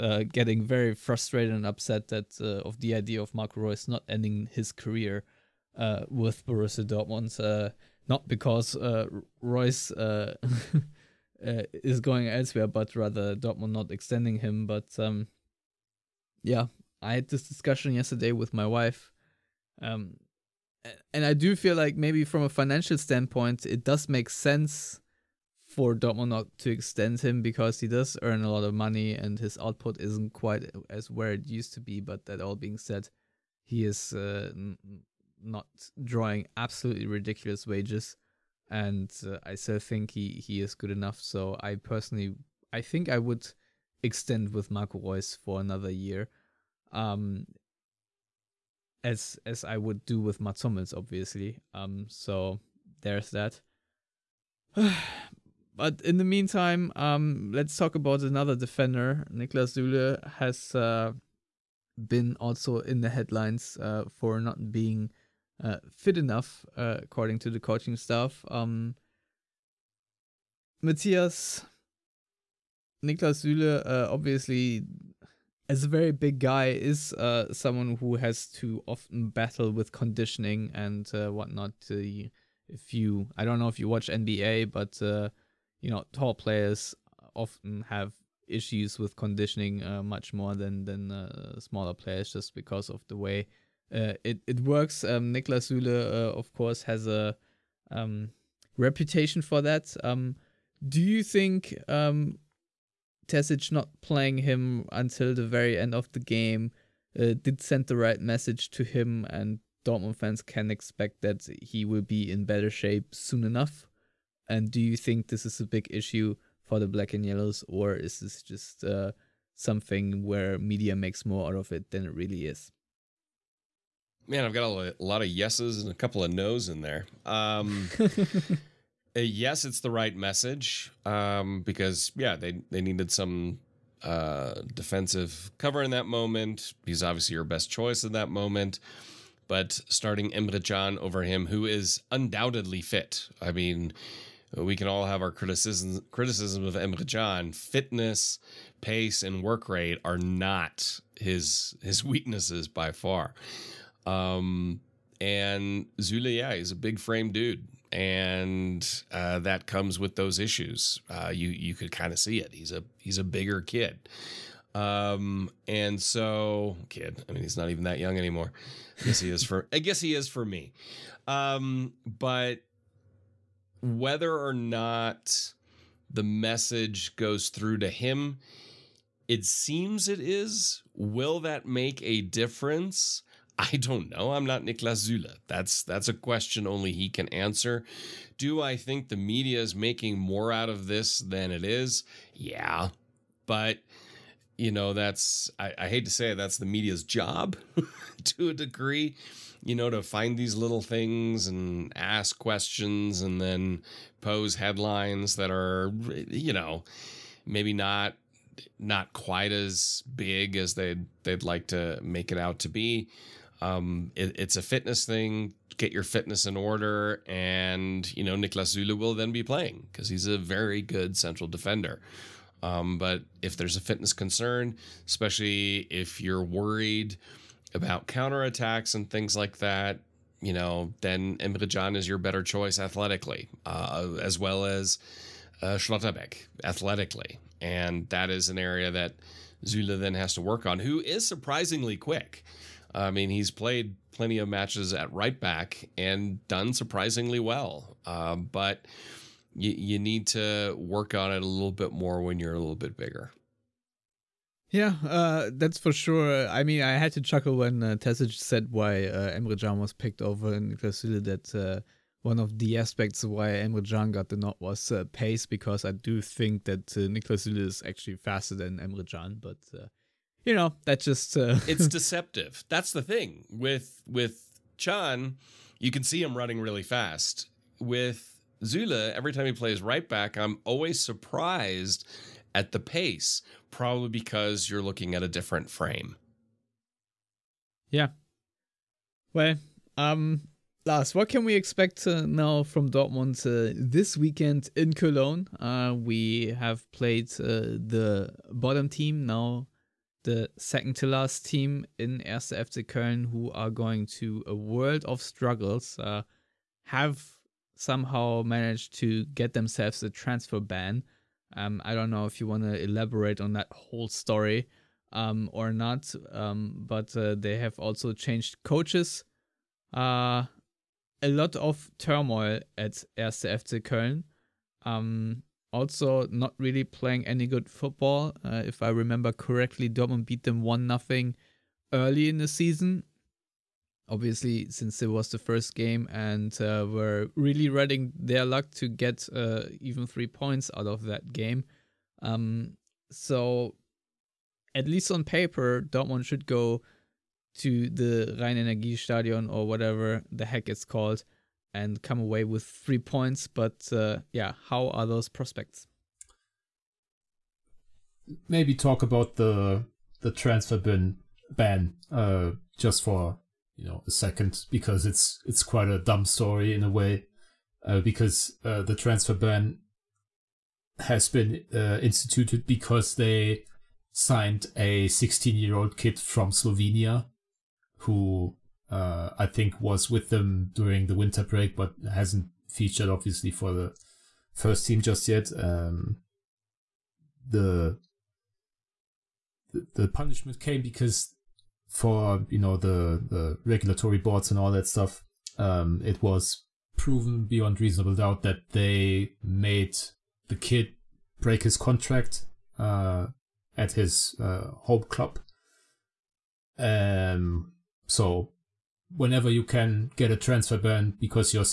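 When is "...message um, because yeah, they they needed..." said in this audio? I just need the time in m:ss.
2:10.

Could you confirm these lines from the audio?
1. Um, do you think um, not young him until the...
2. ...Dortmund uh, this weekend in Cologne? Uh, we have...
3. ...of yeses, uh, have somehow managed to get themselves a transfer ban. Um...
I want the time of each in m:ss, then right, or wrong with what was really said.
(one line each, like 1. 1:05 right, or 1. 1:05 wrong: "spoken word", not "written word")
1. 1:40 wrong: "playing", not "young"
2. 4:52 right
3. 5:05 wrong: "struggles", not "yeses".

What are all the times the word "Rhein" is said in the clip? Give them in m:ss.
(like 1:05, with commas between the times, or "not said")
5:48.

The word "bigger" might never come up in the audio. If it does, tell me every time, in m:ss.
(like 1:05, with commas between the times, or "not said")
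2:43, 4:12.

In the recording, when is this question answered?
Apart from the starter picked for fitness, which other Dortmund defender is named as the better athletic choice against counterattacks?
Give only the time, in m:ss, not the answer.
3:55.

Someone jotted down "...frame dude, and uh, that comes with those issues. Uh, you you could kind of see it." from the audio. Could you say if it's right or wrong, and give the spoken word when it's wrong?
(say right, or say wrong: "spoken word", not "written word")
right.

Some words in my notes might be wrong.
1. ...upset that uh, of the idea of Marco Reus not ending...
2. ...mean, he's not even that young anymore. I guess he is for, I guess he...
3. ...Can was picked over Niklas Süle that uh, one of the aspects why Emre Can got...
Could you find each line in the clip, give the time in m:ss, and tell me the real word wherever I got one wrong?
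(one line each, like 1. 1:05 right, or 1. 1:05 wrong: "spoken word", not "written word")
1. 0:01 right
2. 2:47 right
3. 4:19 right.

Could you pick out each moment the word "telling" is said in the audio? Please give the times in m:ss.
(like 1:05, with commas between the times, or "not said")
not said.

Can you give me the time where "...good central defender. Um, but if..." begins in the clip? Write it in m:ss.
3:40.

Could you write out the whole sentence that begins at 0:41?
So I personally, I think I would extend with Marco Reus for another year.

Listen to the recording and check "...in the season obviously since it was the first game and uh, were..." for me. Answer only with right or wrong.
right.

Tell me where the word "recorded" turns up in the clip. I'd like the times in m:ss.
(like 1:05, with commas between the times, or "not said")
not said.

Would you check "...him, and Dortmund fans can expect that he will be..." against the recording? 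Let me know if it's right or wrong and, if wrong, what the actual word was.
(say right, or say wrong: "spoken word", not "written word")
right.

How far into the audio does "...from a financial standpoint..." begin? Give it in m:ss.
0:22.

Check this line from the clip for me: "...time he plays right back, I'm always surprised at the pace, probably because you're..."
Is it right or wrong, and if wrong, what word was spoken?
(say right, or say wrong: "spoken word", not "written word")
right.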